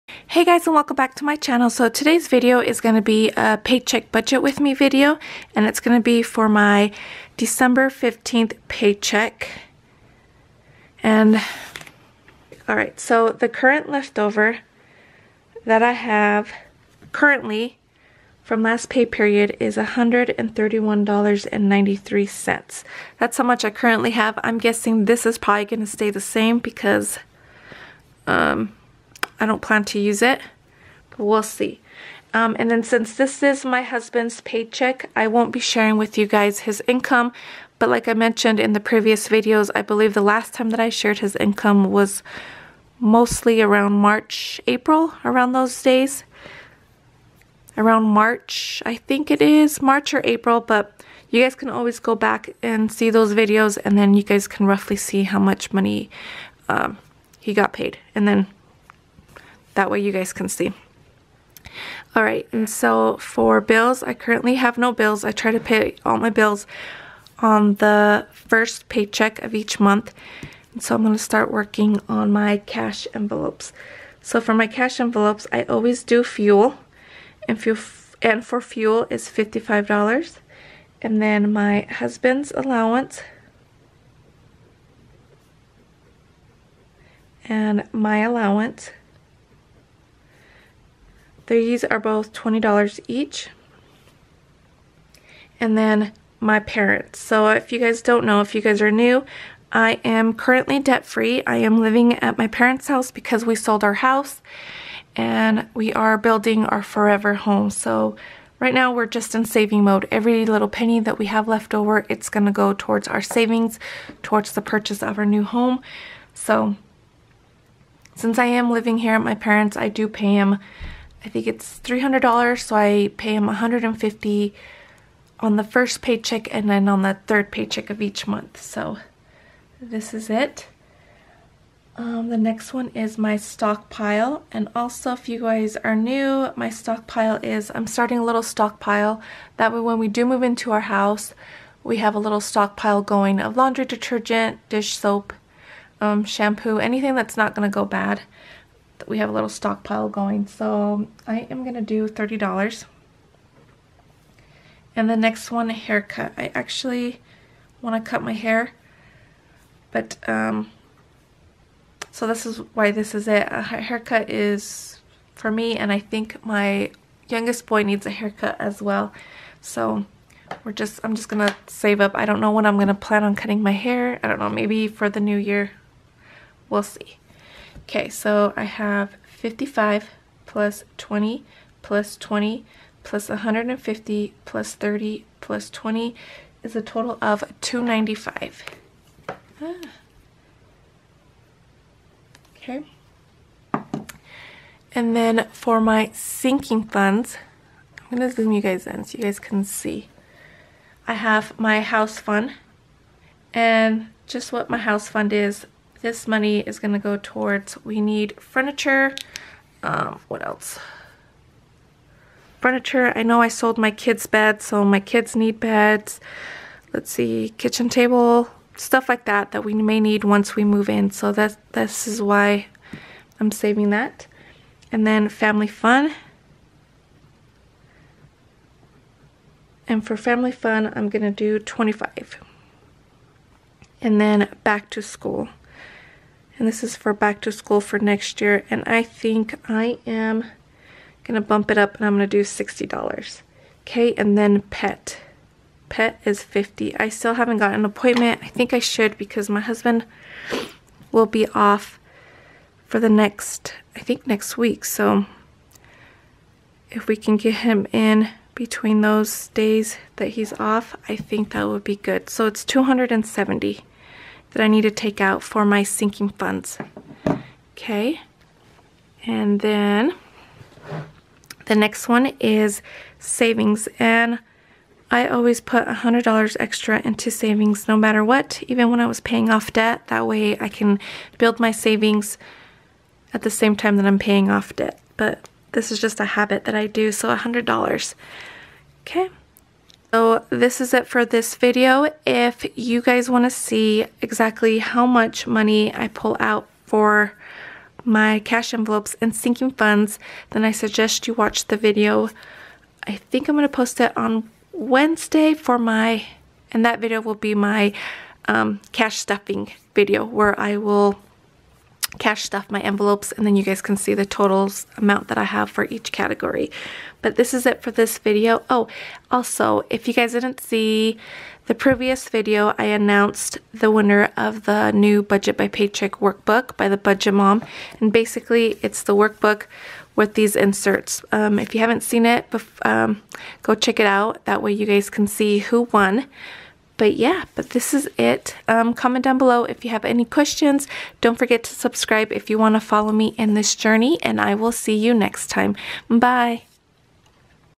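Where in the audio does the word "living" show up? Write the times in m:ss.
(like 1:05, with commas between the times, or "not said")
1:41, 1:58.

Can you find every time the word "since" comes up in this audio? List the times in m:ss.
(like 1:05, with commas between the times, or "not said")
0:32, 1:58.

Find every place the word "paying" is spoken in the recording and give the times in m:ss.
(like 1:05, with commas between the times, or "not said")
4:39, 4:44.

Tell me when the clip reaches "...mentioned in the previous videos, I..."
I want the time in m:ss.
0:38.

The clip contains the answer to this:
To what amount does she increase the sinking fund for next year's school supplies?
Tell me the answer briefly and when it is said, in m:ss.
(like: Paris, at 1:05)
$60, at 4:02.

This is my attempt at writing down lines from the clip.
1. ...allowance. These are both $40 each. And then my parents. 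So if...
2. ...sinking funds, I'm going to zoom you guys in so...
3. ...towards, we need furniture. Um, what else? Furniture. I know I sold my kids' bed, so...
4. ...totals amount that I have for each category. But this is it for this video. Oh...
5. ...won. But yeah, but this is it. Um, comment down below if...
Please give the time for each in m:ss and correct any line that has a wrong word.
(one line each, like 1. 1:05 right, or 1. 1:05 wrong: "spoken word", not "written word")
1. 1:28 wrong: "20", not "40"
2. 3:16 right
3. 3:27 right
4. 5:14 right
5. 5:35 right.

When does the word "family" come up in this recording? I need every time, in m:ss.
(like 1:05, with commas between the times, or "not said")
3:45, 3:50.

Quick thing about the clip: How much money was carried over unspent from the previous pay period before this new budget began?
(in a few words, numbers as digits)
$131.93.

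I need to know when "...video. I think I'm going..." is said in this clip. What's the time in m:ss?
5:01.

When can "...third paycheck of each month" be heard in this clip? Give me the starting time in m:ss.
2:07.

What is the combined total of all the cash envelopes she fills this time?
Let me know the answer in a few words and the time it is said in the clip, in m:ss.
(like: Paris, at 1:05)
295, at 3:07.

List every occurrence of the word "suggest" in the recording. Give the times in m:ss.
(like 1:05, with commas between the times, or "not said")
5:00.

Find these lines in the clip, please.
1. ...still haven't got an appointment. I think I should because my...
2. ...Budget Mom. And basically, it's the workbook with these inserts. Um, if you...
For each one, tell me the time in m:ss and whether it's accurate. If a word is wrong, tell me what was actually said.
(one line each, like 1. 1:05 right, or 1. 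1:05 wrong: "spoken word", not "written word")
1. 4:07 right
2. 5:26 right.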